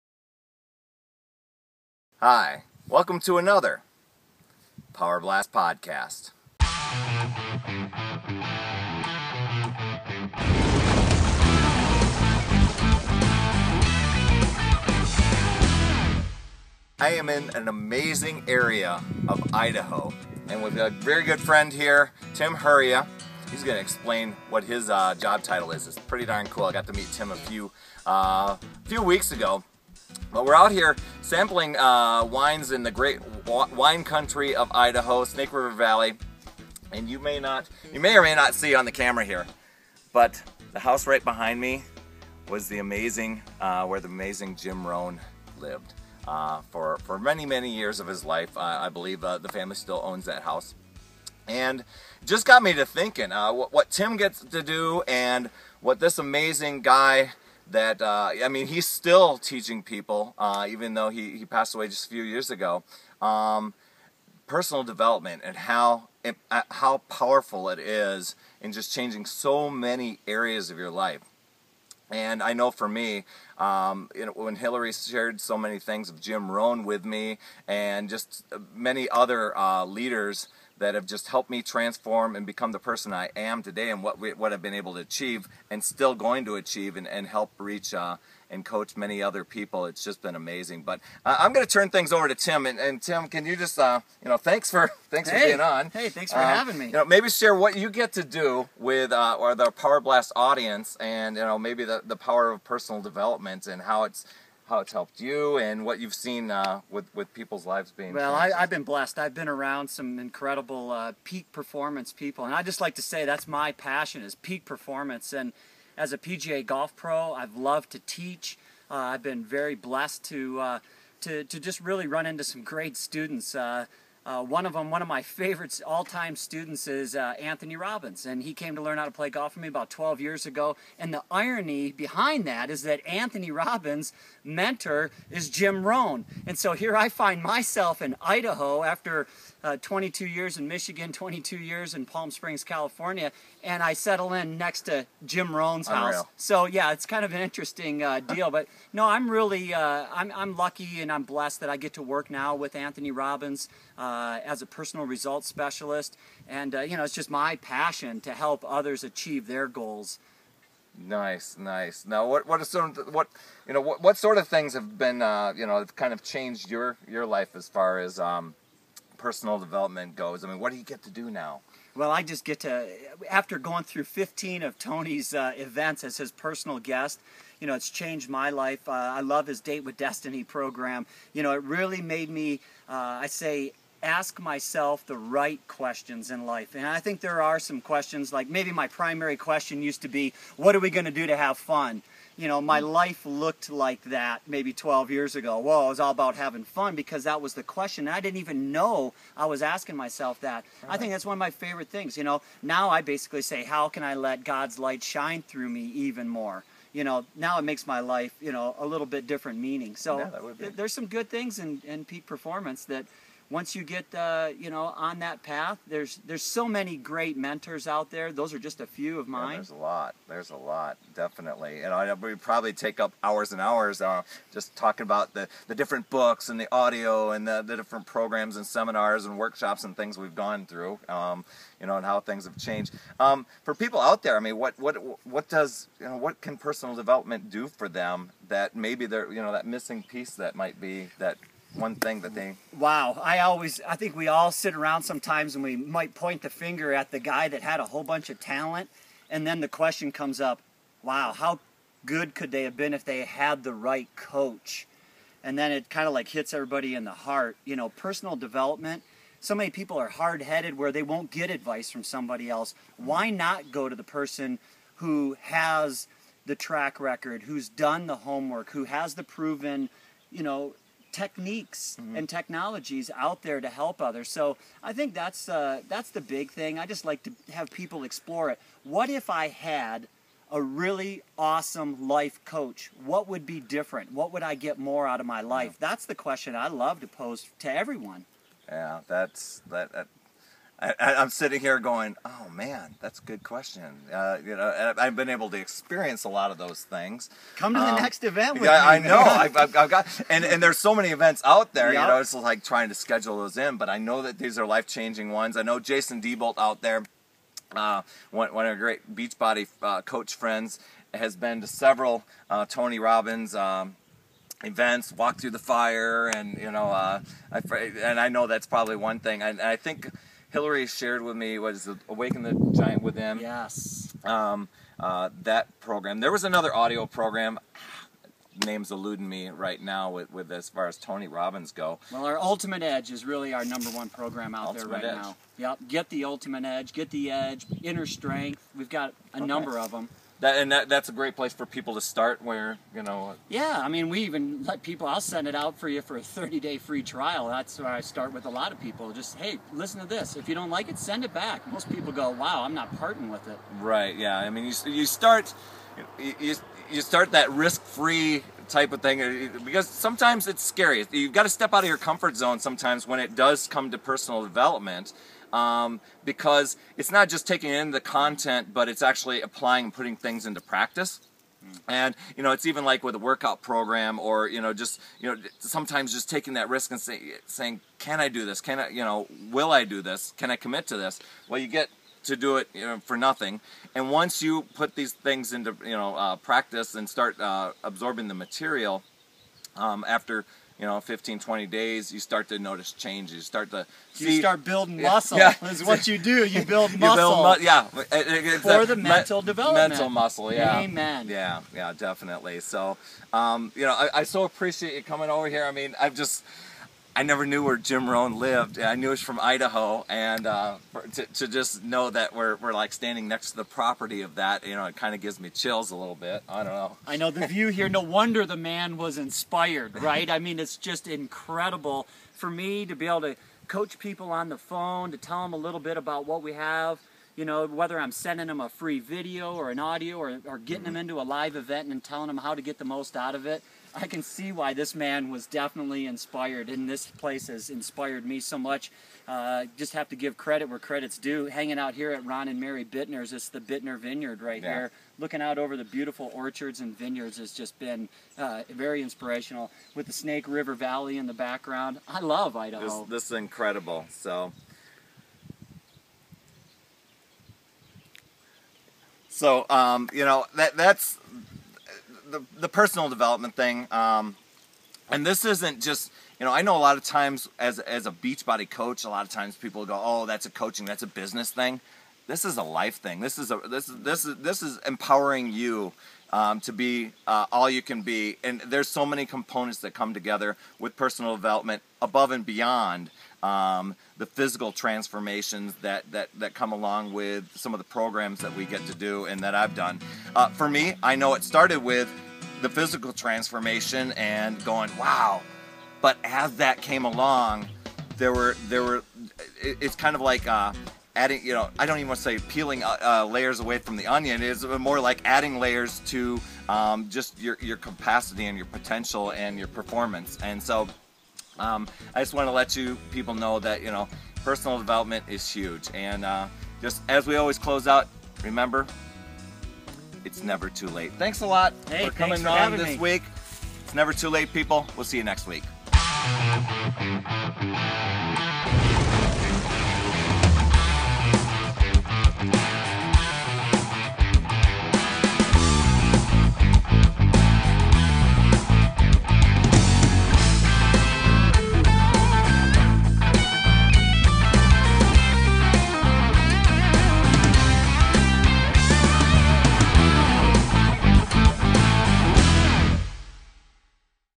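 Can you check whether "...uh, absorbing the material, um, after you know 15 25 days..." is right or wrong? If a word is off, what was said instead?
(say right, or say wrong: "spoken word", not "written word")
wrong: "20", not "25".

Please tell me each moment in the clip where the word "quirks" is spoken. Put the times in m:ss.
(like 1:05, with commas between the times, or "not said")
not said.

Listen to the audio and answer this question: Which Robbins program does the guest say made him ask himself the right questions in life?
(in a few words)
Date with Destiny.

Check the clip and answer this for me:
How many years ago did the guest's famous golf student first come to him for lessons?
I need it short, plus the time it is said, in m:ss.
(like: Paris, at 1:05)
12, at 2:09.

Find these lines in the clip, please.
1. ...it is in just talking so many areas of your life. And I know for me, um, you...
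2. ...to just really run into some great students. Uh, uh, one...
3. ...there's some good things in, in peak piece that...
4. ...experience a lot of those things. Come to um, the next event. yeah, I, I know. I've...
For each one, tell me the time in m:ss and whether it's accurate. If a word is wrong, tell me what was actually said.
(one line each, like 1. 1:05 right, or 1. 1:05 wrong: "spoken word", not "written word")
1. 1:07 wrong: "changing", not "talking"
2. 2:01 right
3. 3:30 wrong: "performance", not "piece"
4. 4:55 right.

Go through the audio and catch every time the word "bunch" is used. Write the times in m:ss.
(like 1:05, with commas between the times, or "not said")
4:08.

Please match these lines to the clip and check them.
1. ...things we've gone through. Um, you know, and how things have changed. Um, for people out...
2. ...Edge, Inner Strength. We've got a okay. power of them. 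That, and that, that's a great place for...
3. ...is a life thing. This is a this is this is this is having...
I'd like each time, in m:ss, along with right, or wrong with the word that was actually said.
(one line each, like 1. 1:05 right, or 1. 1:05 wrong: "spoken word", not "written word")
1. 3:49 right
2. 5:37 wrong: "number", not "power"
3. 7:52 wrong: "empowering", not "having".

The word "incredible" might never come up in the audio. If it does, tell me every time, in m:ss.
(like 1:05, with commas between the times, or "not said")
1:50, 7:01, 7:33.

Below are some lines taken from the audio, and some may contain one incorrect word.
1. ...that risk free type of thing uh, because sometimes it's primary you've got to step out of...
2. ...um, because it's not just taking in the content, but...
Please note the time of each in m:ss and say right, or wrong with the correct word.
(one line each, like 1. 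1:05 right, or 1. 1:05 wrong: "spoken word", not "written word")
1. 5:57 wrong: "scary", not "primary"
2. 6:05 right.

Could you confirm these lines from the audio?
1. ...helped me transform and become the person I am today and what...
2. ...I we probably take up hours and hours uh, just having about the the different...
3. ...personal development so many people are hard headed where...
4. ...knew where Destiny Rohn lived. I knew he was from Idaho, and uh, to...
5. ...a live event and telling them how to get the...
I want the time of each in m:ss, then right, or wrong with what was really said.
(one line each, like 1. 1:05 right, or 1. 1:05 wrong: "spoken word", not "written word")
1. 1:21 right
2. 3:41 wrong: "talking", not "having"
3. 4:17 right
4. 6:47 wrong: "Jim", not "Destiny"
5. 7:11 right.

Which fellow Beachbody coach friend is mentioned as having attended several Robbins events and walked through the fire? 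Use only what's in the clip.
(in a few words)
Jason Dibolt.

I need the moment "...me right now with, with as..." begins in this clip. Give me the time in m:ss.
5:29.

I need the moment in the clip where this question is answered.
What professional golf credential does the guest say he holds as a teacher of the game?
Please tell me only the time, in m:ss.
1:56.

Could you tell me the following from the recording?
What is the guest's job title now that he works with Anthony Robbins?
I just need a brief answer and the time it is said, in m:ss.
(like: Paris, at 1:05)
Personal results specialist, at 2:34.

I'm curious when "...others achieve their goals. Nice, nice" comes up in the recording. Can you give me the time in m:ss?
2:38.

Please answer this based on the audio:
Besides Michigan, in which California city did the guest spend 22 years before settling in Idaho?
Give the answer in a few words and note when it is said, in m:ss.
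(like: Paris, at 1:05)
Palm Springs, at 2:22.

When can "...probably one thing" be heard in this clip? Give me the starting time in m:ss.
5:18.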